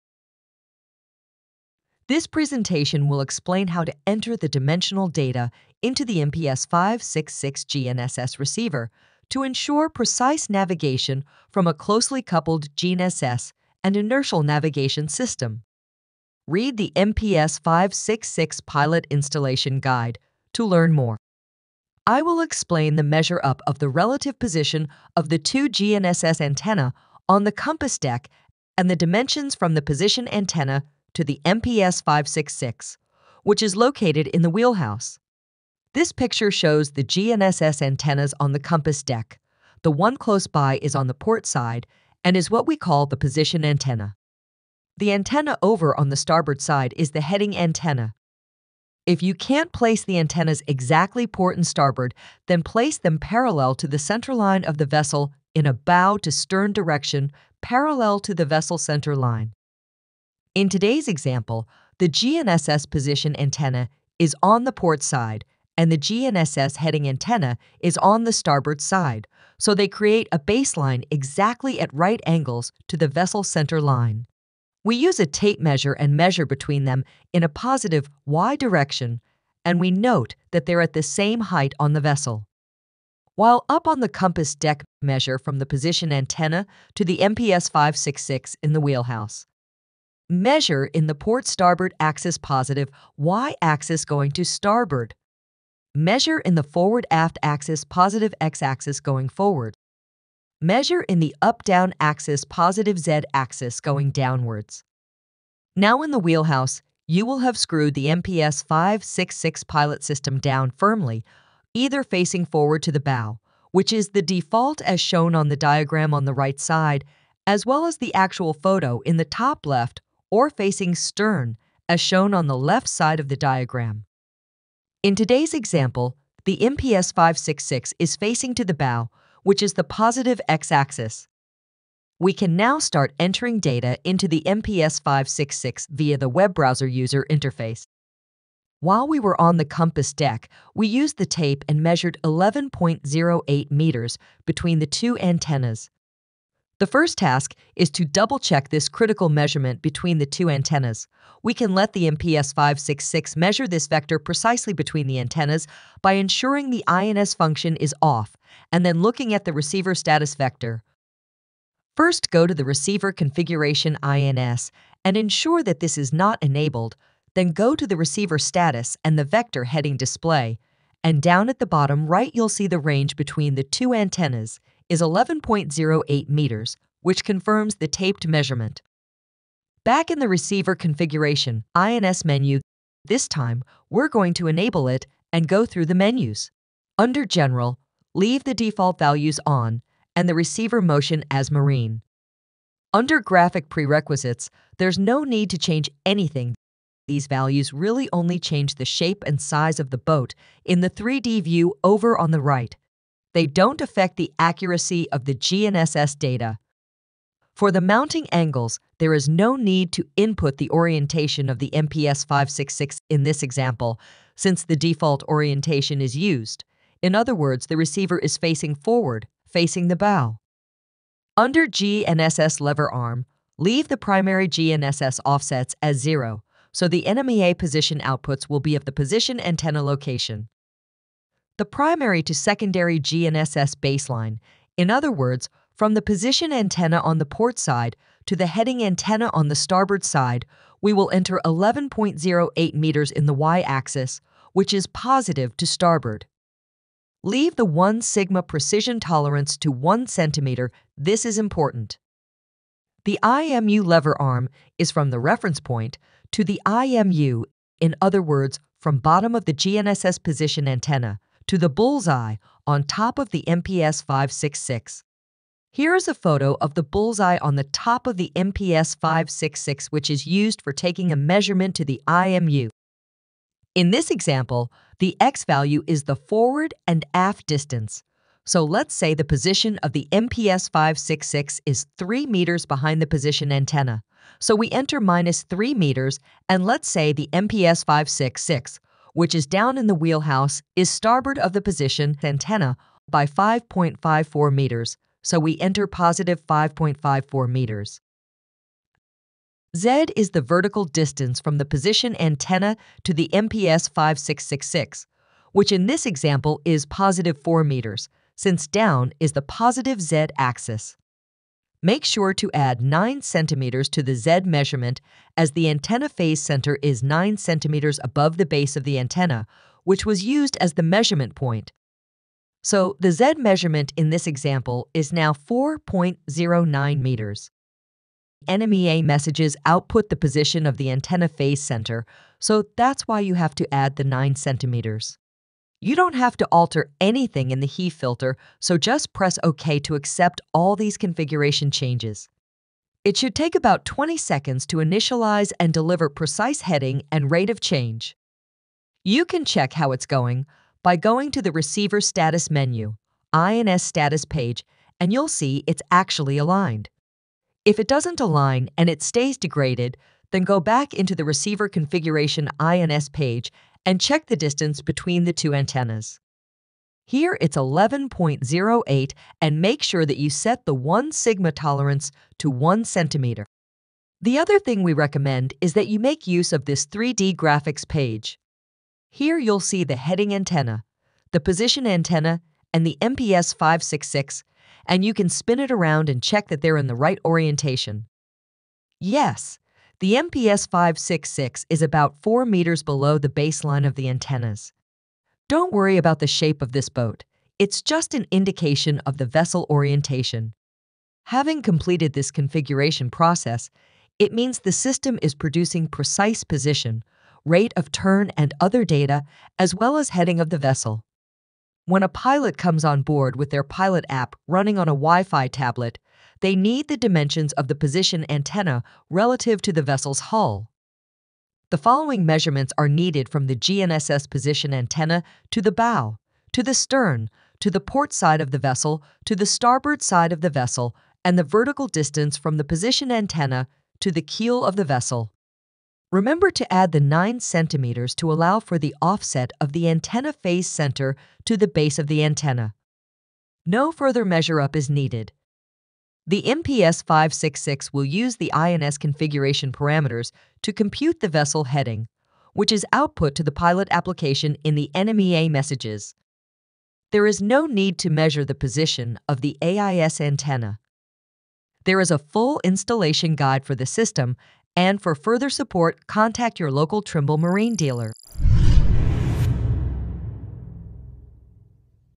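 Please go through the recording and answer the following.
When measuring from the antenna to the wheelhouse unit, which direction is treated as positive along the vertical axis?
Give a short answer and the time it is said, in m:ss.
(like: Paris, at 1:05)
Downwards, at 1:43.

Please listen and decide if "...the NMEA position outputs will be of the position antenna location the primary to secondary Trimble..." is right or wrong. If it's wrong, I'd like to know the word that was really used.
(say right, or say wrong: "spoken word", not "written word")
wrong: "GNSS", not "Trimble".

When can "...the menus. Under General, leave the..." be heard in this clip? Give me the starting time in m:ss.
3:05.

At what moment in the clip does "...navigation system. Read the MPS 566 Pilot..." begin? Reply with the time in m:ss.
0:14.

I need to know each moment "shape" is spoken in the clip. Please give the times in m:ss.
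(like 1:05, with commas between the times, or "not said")
3:18, 6:36.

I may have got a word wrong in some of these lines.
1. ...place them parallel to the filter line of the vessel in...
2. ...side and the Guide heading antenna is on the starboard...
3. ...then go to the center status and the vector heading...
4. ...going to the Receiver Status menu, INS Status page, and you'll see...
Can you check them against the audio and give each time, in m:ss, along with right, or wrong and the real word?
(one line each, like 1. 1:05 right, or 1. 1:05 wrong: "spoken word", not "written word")
1. 0:52 wrong: "center", not "filter"
2. 1:05 wrong: "GNSS", not "Guide"
3. 2:47 wrong: "receiver", not "center"
4. 5:50 right.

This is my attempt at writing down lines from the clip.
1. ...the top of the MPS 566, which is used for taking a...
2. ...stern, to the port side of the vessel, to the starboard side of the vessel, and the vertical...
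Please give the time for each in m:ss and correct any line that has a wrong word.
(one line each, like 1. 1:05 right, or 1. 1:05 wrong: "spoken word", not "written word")
1. 4:27 right
2. 7:06 right.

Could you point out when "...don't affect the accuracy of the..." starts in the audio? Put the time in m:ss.
3:23.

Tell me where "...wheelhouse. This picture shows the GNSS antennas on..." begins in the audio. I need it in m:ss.
0:34.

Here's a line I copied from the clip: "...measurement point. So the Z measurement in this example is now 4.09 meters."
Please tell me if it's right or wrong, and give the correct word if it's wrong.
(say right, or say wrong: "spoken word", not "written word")
right.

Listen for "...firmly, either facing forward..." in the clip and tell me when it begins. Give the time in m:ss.
1:50.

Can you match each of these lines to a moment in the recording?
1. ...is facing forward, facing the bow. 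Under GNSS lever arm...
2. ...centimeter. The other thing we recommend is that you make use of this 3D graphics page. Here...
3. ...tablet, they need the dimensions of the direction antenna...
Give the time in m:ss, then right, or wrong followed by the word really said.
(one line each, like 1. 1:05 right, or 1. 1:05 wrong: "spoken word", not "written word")
1. 3:38 right
2. 6:12 right
3. 6:55 wrong: "position", not "direction".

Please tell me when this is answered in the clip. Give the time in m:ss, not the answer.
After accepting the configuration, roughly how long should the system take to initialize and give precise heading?
5:43.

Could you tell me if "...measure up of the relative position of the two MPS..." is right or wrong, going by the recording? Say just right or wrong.
wrong.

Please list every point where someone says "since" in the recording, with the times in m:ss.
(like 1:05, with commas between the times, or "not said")
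3:34, 5:08.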